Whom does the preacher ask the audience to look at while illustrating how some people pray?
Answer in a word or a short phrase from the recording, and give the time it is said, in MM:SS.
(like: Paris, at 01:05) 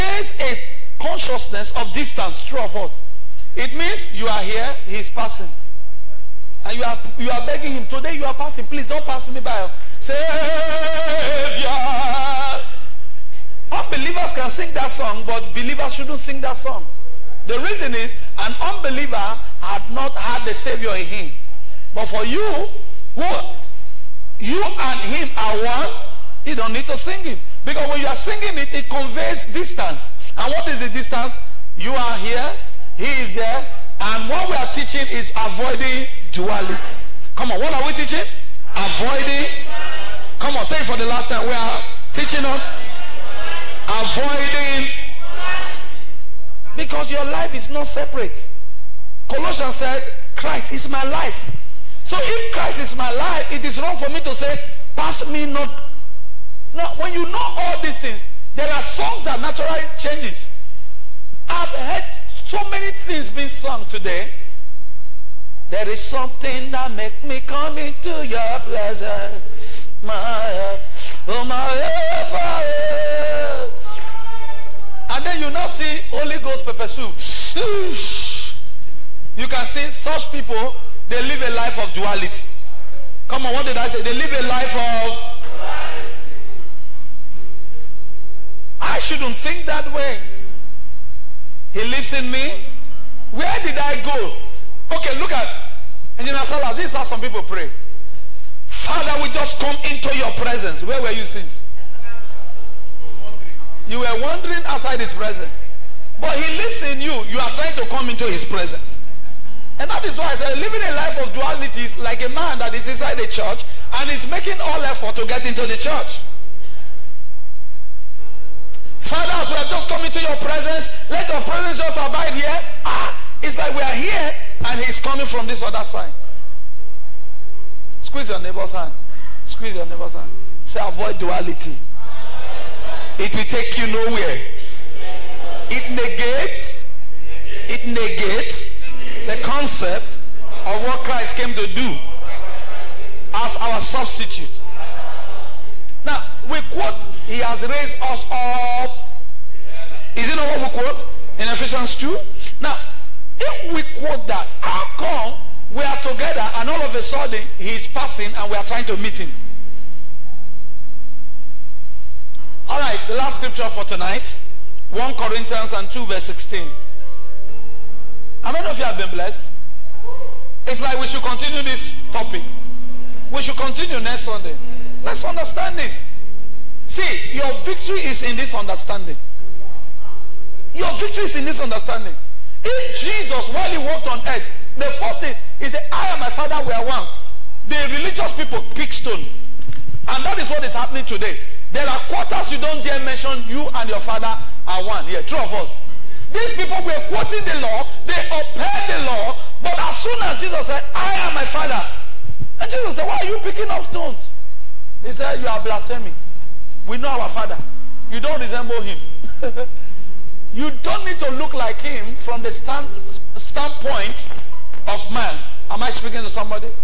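Engineer Salas, at 01:36.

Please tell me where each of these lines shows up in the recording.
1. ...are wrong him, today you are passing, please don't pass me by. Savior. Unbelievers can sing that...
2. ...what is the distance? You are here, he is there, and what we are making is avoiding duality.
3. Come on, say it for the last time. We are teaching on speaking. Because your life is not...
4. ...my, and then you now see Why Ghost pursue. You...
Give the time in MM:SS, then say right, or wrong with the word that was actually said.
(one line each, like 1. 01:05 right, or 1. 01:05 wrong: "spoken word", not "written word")
1. 00:07 wrong: "begging", not "wrong"
2. 00:30 wrong: "teaching", not "making"
3. 00:40 wrong: "avoiding", not "speaking"
4. 01:11 wrong: "Holy", not "Why".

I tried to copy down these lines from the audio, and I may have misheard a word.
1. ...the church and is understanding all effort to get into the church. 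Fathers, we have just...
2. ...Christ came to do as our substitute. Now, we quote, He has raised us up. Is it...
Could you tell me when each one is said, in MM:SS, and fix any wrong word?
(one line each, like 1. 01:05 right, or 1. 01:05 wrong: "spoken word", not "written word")
1. 01:53 wrong: "making", not "understanding"
2. 02:20 right.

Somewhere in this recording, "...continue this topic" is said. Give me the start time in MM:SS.
02:51.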